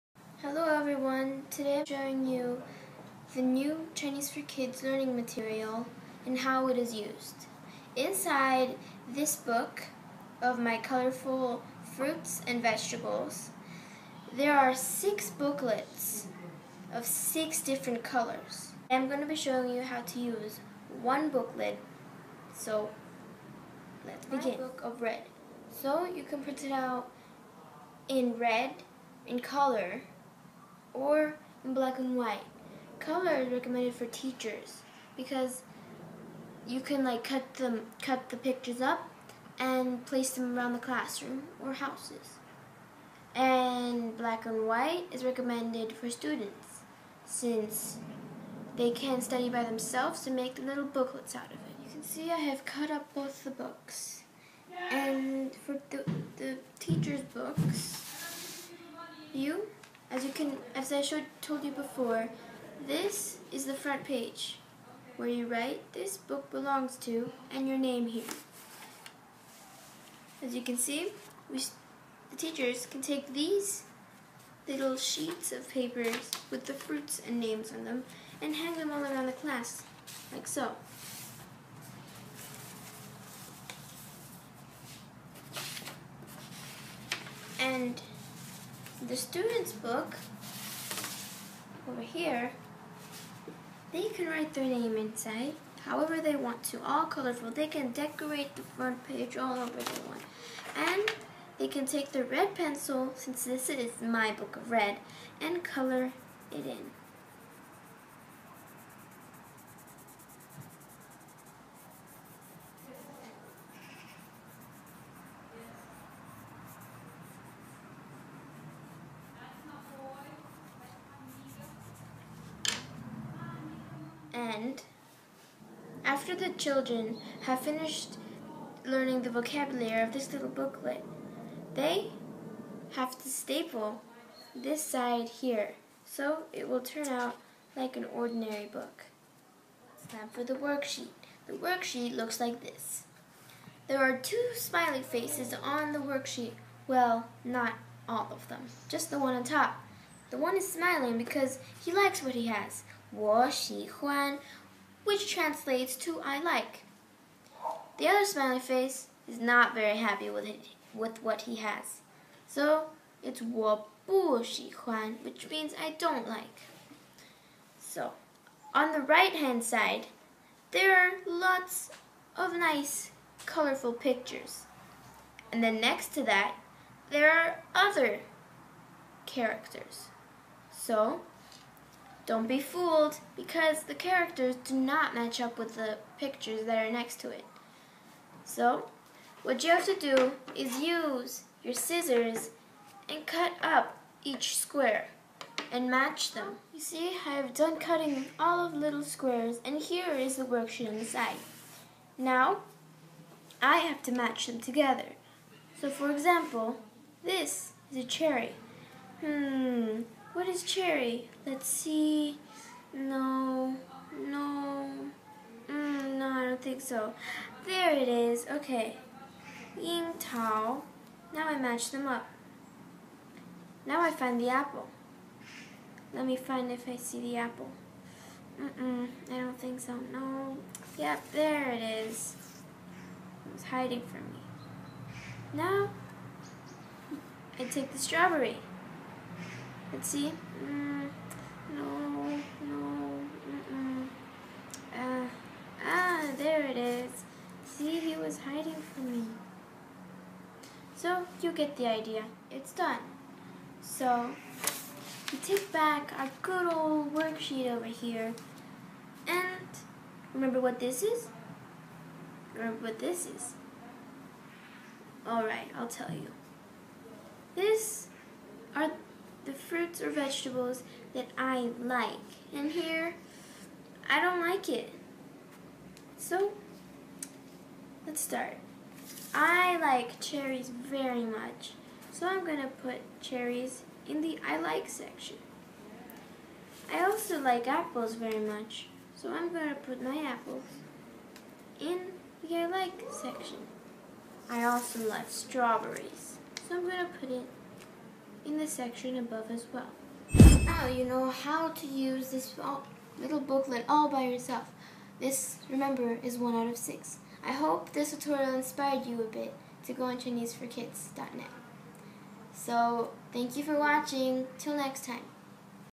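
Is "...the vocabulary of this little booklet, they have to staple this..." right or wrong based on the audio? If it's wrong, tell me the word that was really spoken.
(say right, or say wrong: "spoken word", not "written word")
right.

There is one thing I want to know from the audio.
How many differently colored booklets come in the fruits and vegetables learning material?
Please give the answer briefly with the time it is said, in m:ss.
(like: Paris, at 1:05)
6, at 0:14.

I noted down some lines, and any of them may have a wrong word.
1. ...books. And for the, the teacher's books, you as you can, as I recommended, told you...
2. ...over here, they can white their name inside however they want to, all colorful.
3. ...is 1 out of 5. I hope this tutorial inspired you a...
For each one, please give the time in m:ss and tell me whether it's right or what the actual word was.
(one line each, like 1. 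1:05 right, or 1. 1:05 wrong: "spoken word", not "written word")
1. 0:53 wrong: "showed", not "recommended"
2. 1:31 wrong: "write", not "white"
3. 5:06 wrong: "6", not "5".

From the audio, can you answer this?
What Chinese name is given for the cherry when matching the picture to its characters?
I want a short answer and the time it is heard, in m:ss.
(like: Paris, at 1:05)
Ying Tao, at 3:39.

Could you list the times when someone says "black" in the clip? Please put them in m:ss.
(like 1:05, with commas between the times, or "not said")
0:31, 0:44.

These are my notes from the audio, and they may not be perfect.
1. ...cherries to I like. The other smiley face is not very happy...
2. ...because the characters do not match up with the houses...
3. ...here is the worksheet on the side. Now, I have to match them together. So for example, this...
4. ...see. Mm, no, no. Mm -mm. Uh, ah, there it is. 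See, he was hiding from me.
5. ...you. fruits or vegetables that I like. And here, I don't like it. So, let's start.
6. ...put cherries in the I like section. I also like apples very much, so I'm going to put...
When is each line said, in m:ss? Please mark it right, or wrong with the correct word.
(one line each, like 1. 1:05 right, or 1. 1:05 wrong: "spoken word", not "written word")
1. 2:35 wrong: "translates", not "cherries"
2. 3:03 wrong: "pictures", not "houses"
3. 3:19 right
4. 4:00 right
5. 4:26 right
6. 4:42 right.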